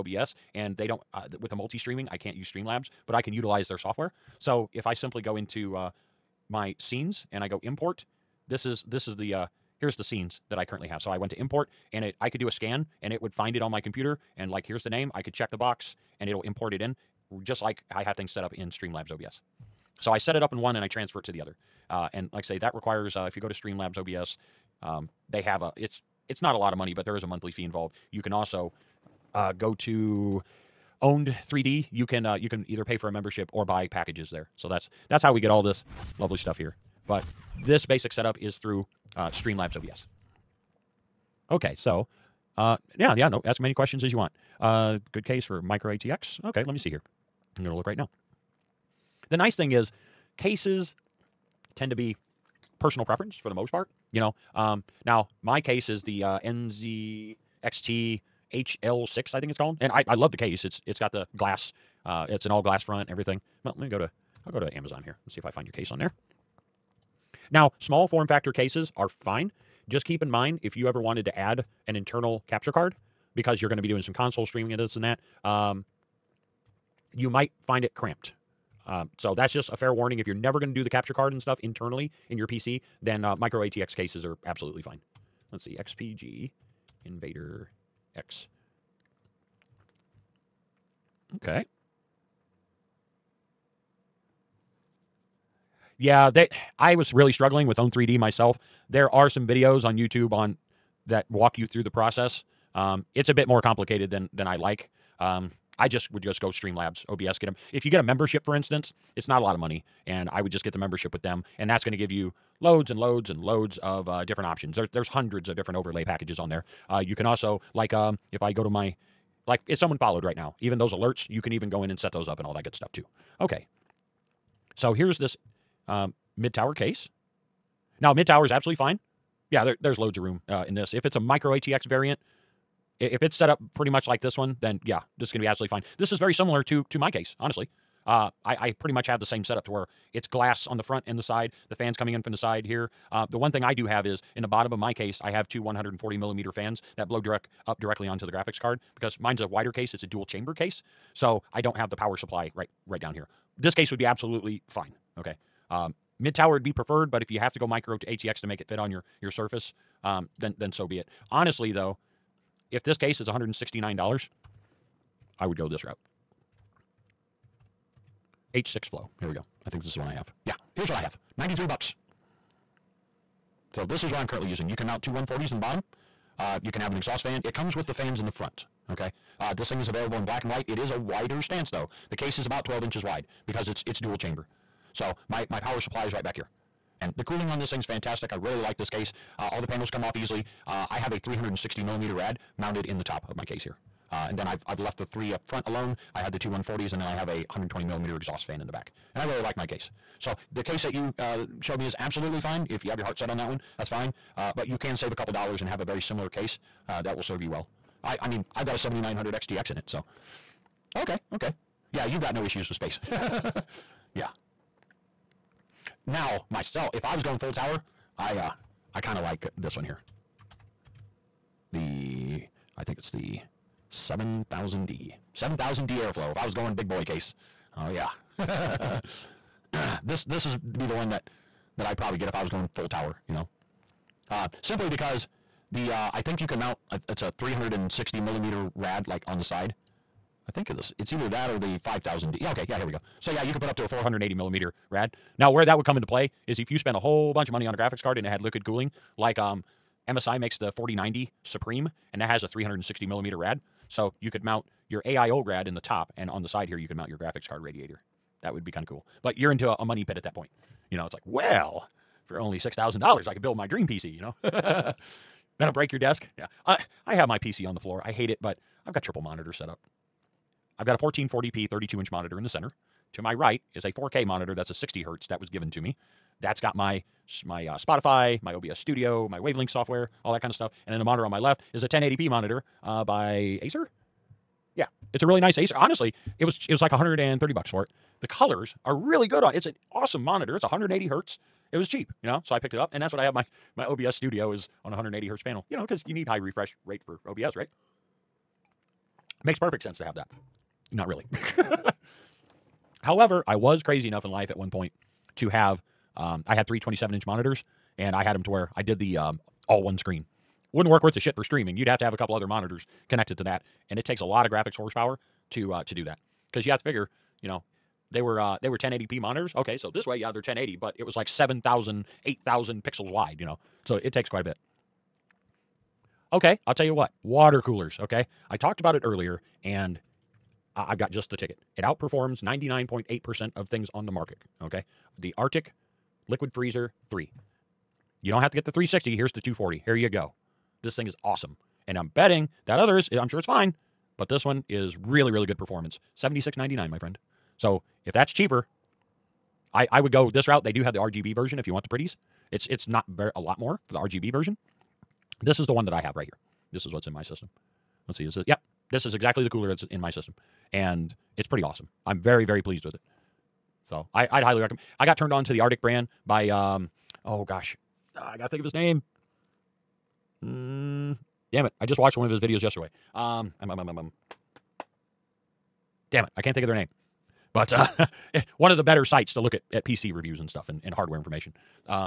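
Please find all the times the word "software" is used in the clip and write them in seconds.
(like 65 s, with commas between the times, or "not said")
3 s, 279 s.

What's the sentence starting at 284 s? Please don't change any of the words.
Yeah, it's a really nice Acer.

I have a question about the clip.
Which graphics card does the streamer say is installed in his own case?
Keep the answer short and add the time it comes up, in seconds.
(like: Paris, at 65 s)
7900 XTX, at 208 s.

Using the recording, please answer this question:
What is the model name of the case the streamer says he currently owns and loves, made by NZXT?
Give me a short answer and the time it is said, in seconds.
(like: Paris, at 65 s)
HL6, at 58 s.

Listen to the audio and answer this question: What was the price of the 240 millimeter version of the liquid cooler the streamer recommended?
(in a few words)
$76.99.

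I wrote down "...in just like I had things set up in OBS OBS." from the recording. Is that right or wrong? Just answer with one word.
wrong.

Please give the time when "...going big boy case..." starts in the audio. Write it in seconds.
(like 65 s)
226 s.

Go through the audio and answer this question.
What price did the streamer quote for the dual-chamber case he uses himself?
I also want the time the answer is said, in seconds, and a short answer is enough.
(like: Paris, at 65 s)
$93, at 171 s.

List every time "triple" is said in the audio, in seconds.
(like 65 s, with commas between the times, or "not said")
269 s.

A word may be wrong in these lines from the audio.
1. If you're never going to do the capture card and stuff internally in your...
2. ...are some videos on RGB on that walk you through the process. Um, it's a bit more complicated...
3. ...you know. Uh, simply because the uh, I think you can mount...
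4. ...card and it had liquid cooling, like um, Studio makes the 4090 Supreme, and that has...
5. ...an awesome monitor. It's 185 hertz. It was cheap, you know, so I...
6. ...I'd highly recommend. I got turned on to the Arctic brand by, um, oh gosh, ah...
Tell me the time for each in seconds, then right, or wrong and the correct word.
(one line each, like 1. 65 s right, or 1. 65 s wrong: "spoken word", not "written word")
1. 80 s right
2. 99 s wrong: "YouTube", not "RGB"
3. 233 s right
4. 248 s wrong: "MSI", not "Studio"
5. 289 s wrong: "180", not "185"
6. 364 s right.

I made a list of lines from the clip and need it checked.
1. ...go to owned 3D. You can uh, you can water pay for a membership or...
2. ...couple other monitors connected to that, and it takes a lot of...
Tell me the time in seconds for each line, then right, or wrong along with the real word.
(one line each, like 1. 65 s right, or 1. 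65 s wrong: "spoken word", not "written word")
1. 29 s wrong: "either", not "water"
2. 312 s right.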